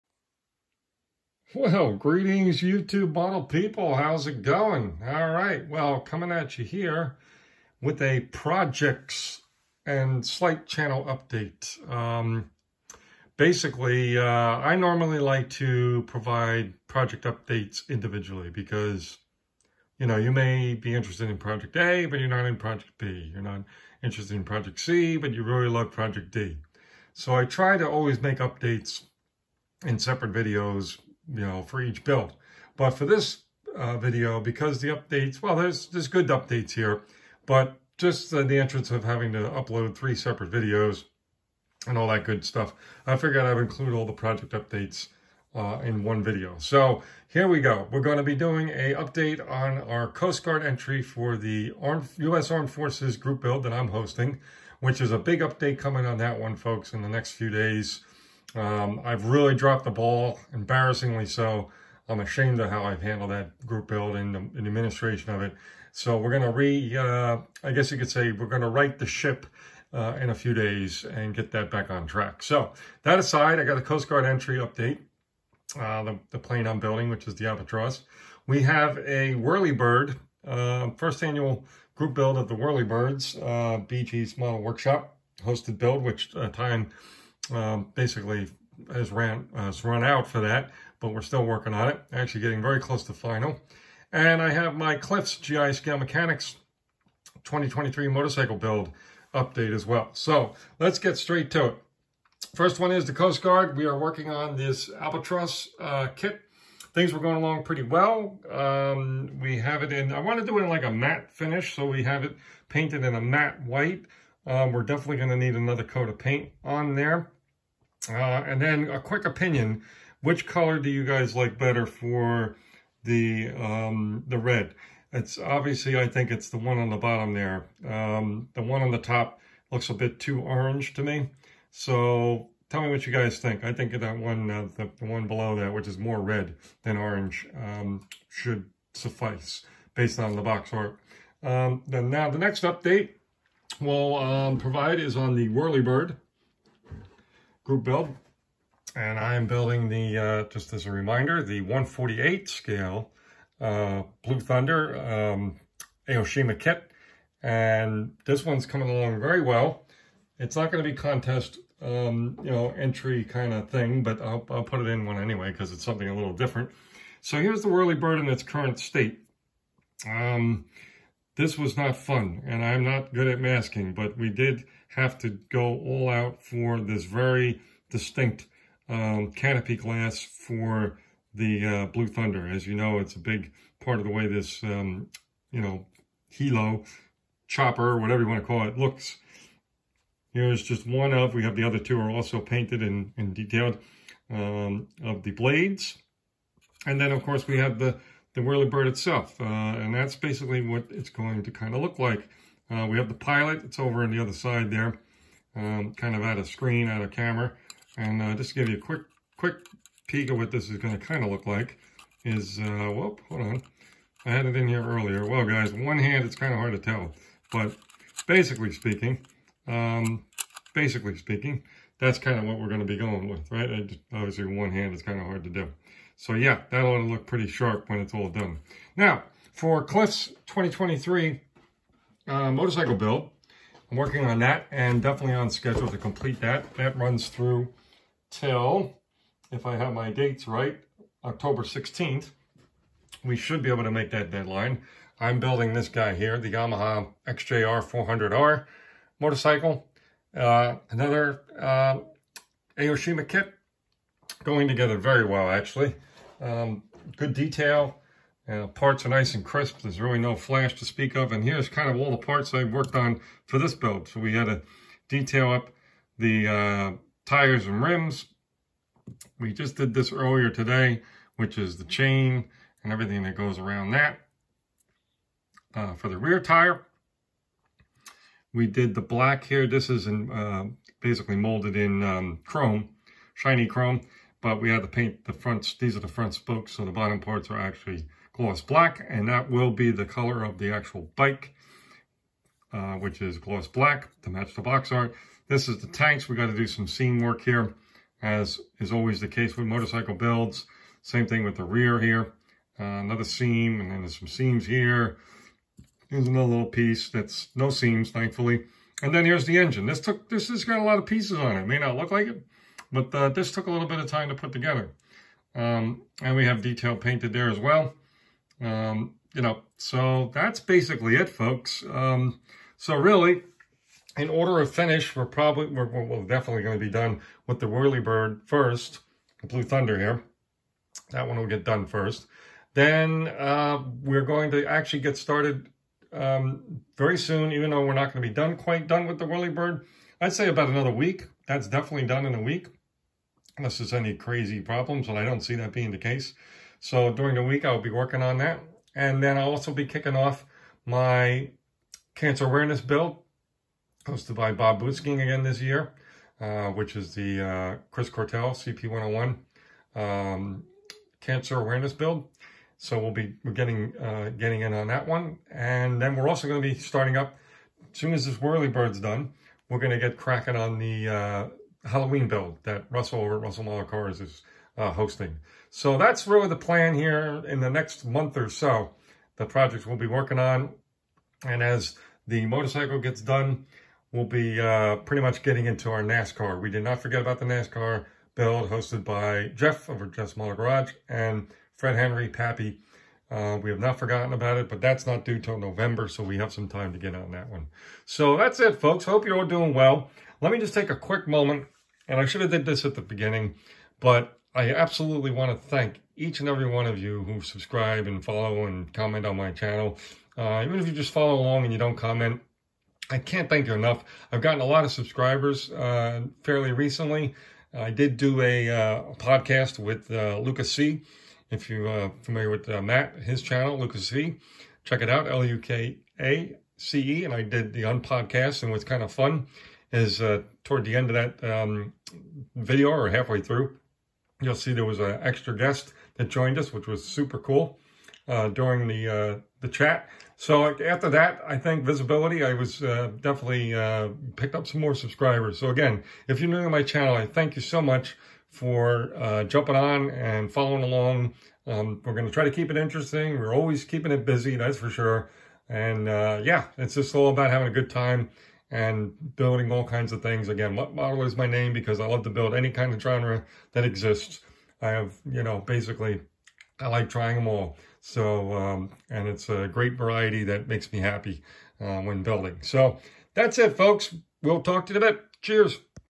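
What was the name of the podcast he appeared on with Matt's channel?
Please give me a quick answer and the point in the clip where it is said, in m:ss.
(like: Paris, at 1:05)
Unpodcast, at 7:07.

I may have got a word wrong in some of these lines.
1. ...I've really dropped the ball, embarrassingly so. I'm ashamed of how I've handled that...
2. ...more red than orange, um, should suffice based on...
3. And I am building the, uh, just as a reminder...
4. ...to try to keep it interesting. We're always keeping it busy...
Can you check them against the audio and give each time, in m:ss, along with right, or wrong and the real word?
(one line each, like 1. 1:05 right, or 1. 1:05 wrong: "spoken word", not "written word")
1. 0:59 right
2. 2:15 right
3. 2:28 right
4. 7:32 right.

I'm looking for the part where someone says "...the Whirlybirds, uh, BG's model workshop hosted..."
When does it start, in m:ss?
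1:22.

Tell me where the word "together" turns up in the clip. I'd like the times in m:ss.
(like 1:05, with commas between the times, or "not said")
4:14, 5:14.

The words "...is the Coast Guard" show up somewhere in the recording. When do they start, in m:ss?
1:42.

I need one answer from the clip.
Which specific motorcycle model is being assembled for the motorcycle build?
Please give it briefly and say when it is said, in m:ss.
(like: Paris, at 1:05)
Yamaha XJR 400R, at 4:06.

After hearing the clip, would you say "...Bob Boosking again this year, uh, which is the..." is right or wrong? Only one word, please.
right.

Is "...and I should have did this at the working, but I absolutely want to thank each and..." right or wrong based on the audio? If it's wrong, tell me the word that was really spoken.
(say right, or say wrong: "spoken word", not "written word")
wrong: "beginning", not "working".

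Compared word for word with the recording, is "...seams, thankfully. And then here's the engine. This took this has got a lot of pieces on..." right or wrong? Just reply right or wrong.
right.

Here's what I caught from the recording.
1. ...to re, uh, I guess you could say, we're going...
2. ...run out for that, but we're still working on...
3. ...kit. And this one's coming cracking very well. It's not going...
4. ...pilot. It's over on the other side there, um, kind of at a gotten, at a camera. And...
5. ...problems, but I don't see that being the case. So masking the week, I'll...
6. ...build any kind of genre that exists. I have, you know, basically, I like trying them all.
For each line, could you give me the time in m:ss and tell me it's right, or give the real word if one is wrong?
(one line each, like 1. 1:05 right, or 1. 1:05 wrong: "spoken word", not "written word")
1. 1:06 right
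2. 1:29 right
3. 2:36 wrong: "along", not "cracking"
4. 3:23 wrong: "screen", not "gotten"
5. 5:44 wrong: "during", not "masking"
6. 7:42 right.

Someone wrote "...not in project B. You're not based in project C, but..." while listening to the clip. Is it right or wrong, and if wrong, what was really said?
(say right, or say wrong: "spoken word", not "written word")
wrong: "interested", not "based".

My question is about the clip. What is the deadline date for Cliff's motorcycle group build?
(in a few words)
October 16th.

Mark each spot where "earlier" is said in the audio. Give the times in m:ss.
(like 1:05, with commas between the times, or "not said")
3:34, 4:30.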